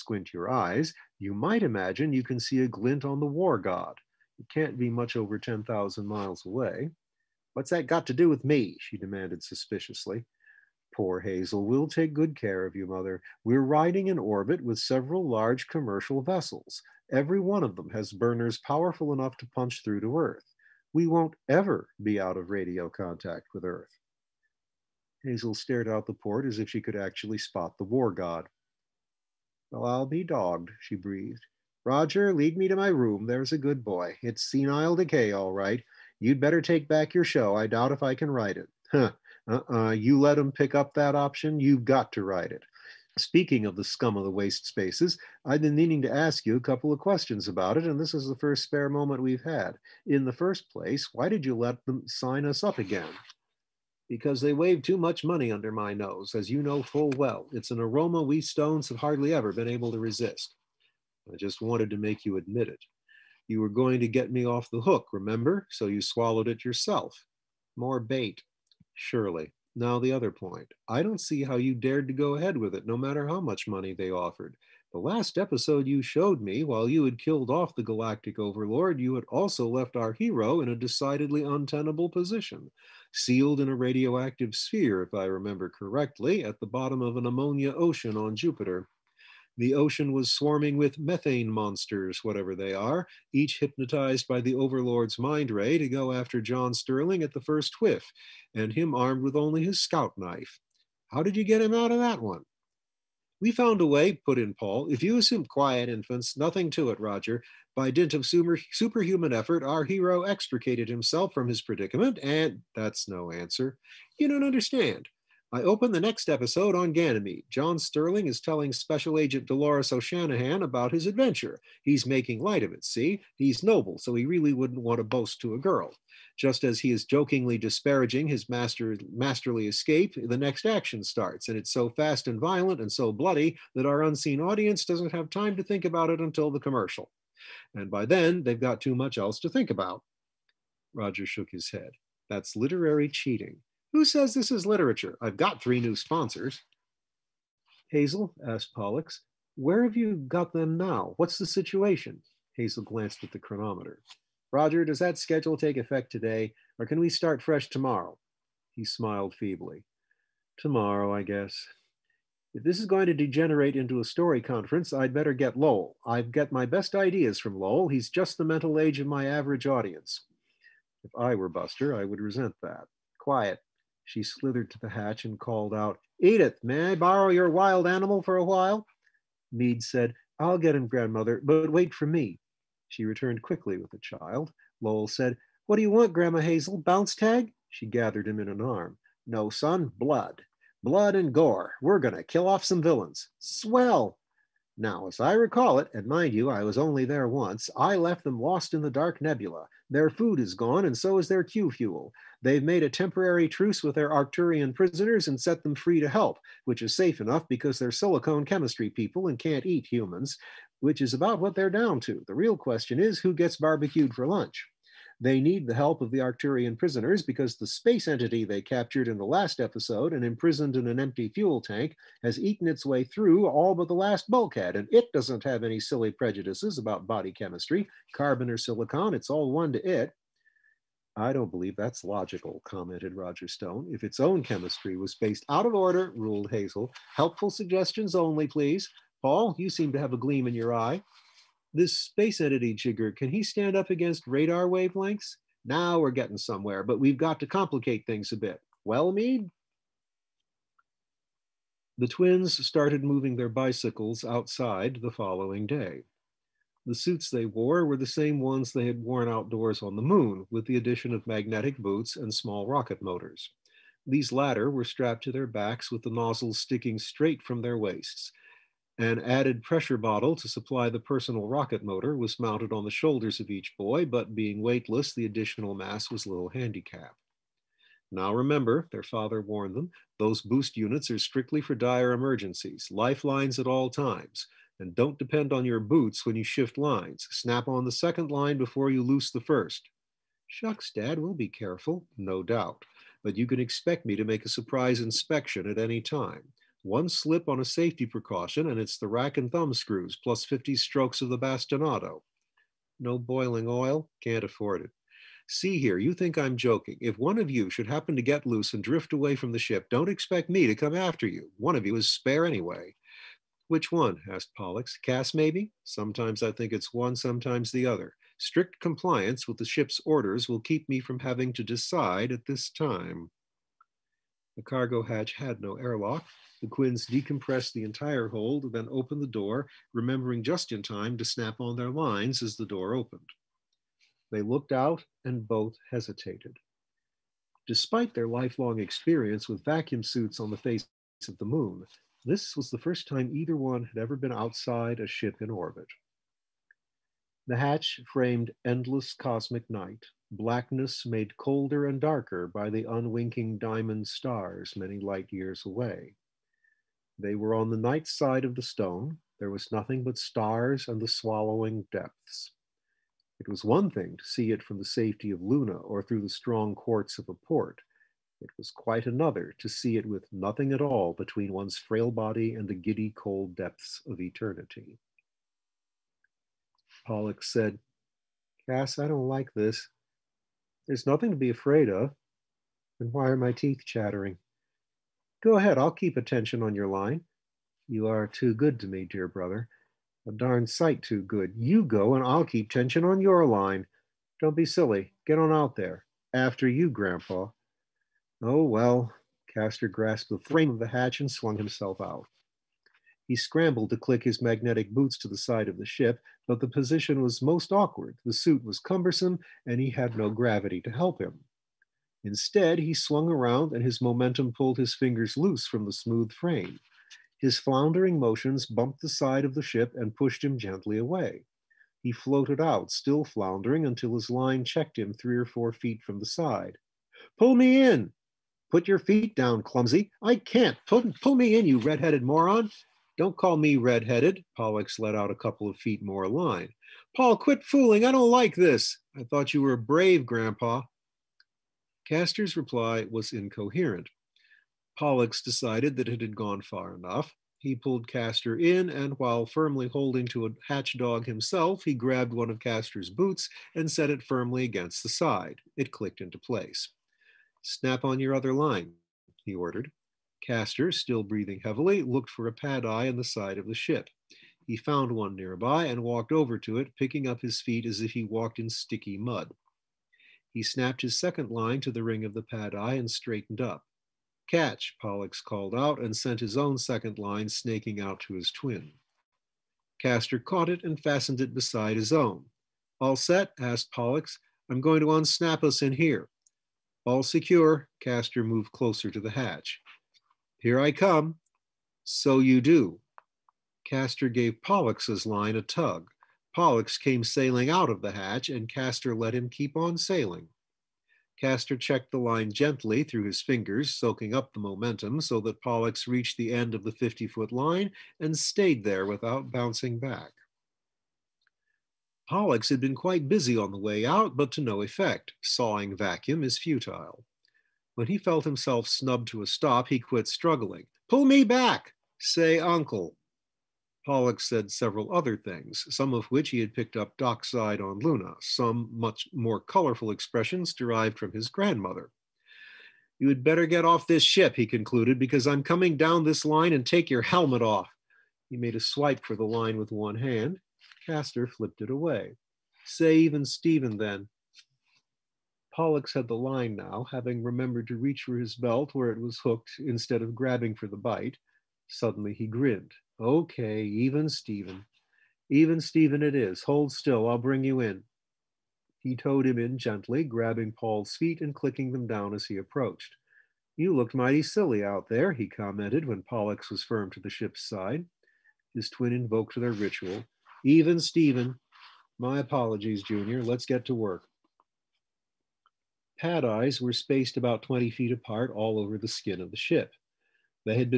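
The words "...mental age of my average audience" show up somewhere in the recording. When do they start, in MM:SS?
02:48.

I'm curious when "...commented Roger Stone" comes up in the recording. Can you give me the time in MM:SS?
03:52.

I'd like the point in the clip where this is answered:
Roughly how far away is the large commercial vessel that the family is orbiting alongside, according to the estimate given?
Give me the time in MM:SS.
00:05.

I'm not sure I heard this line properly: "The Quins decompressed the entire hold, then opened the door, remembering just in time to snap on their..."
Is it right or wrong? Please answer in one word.
right.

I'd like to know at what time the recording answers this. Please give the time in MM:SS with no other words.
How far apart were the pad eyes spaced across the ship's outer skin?
09:37.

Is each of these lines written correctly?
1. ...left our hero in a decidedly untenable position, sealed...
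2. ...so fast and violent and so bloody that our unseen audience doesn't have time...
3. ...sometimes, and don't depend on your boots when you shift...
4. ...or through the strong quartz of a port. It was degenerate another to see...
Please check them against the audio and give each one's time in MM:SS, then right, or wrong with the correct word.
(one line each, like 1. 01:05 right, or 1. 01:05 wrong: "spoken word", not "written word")
1. 01:19 right
2. 02:11 right
3. 04:43 wrong: "times", not "sometimes"
4. 06:05 wrong: "quite", not "degenerate".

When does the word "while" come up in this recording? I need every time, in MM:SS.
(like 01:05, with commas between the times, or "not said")
01:16, 02:58, 07:29.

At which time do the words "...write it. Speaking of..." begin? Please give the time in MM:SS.
00:42.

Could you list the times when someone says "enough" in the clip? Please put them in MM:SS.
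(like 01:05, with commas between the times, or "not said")
00:19, 03:27, 07:26.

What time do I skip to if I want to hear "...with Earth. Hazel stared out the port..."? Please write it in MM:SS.
00:23.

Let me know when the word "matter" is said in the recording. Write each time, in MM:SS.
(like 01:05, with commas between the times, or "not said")
01:12.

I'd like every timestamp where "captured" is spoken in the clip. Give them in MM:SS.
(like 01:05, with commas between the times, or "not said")
03:38.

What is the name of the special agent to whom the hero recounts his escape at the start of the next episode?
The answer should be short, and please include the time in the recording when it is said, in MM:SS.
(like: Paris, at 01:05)
Dolores O'Shanahan, at 01:59.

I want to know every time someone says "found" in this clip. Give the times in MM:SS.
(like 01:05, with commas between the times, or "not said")
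01:43, 07:44.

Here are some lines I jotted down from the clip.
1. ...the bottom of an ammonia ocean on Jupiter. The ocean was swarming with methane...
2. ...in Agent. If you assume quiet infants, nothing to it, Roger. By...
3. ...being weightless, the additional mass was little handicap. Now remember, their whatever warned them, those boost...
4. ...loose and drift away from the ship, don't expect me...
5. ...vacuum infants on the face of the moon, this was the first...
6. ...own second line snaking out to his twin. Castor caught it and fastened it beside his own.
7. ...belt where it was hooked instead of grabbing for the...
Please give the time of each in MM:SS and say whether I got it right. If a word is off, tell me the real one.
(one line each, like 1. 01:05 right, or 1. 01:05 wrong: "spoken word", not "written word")
1. 01:26 right
2. 01:44 wrong: "Paul", not "Agent"
3. 04:34 wrong: "father", not "whatever"
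4. 05:08 right
5. 05:39 wrong: "suits", not "infants"
6. 07:56 right
7. 09:08 right.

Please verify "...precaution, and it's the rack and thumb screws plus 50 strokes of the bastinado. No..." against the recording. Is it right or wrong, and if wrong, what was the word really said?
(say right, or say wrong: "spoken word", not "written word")
right.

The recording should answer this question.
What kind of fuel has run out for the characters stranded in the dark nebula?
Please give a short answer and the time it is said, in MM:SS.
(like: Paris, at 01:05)
Q fuel, at 03:21.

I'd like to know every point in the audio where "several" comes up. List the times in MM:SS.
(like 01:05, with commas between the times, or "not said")
00:14, 08:44.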